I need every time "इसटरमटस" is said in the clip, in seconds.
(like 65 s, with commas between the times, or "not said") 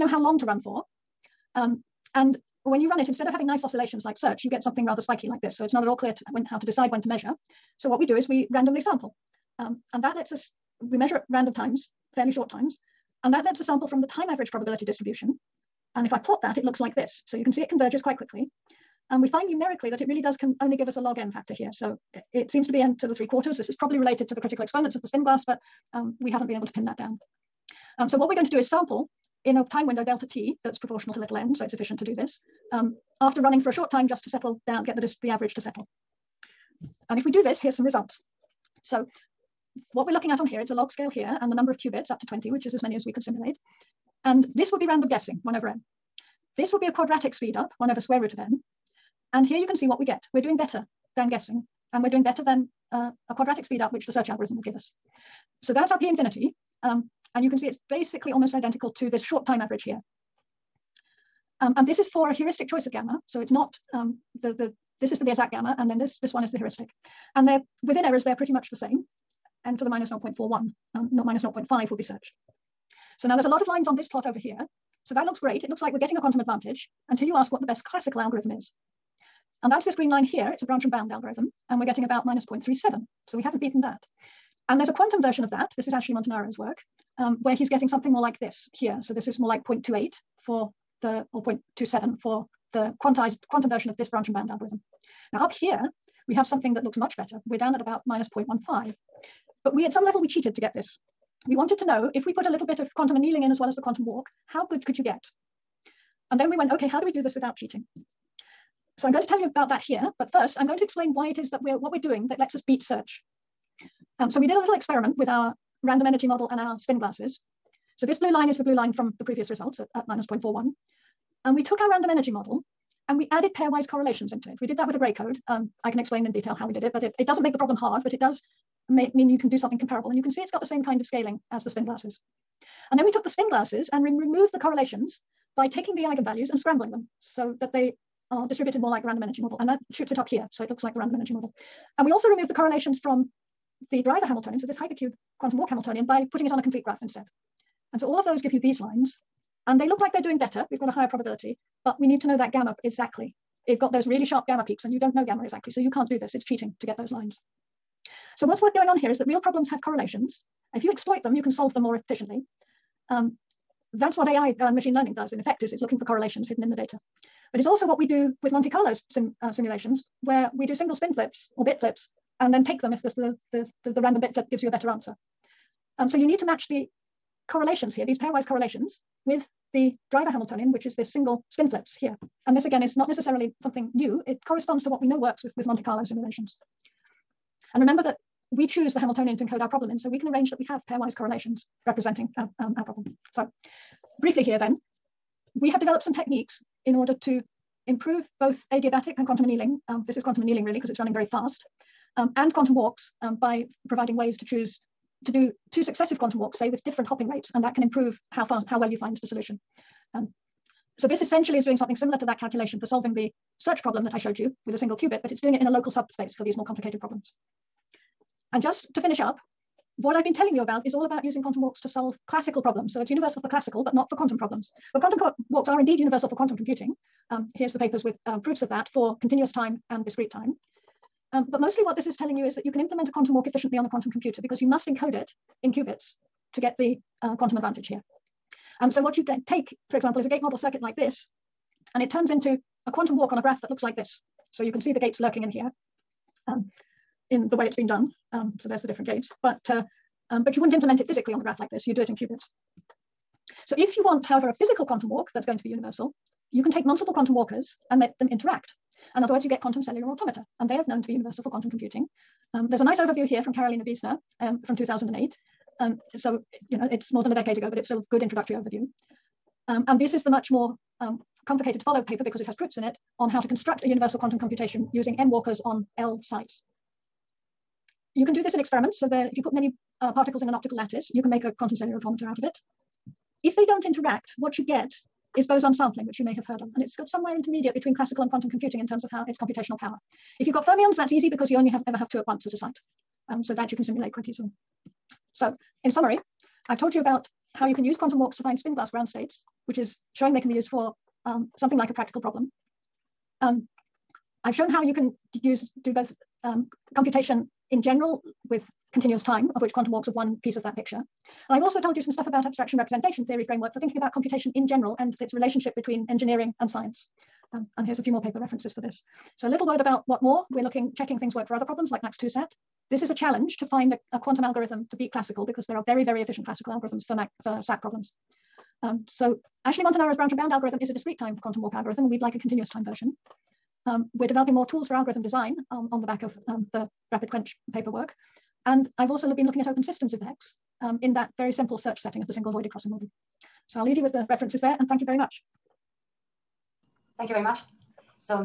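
not said.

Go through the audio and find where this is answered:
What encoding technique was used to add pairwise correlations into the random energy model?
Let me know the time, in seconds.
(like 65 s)
124 s.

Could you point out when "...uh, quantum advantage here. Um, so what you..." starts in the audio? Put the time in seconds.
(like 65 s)
237 s.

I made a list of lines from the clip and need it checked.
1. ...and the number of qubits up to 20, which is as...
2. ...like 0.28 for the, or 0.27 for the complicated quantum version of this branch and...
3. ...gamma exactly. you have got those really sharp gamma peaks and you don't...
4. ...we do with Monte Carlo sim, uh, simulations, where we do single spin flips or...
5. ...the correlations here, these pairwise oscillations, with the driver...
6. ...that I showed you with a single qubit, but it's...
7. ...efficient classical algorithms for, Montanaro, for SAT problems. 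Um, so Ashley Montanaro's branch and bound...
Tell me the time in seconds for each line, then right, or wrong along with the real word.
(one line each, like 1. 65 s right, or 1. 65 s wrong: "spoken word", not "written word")
1. 41 s right
2. 89 s wrong: "quantized", not "complicated"
3. 152 s right
4. 167 s right
5. 176 s wrong: "correlations", not "oscillations"
6. 214 s right
7. 326 s wrong: "MAC", not "Montanaro".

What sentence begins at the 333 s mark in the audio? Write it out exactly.
Um, we're developing more tools for algorithm design um, on the back of um, the rapid quench paperwork.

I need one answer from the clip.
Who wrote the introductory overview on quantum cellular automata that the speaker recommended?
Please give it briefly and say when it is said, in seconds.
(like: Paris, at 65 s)
Karoline Wiesner, at 263 s.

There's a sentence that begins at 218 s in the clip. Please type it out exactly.
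And just to finish up, what I've been telling you about is all about using quantum walks to solve classical problems.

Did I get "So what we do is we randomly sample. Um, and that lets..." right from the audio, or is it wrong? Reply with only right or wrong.
right.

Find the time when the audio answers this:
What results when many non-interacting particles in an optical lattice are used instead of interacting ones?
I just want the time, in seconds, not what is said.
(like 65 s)
285 s.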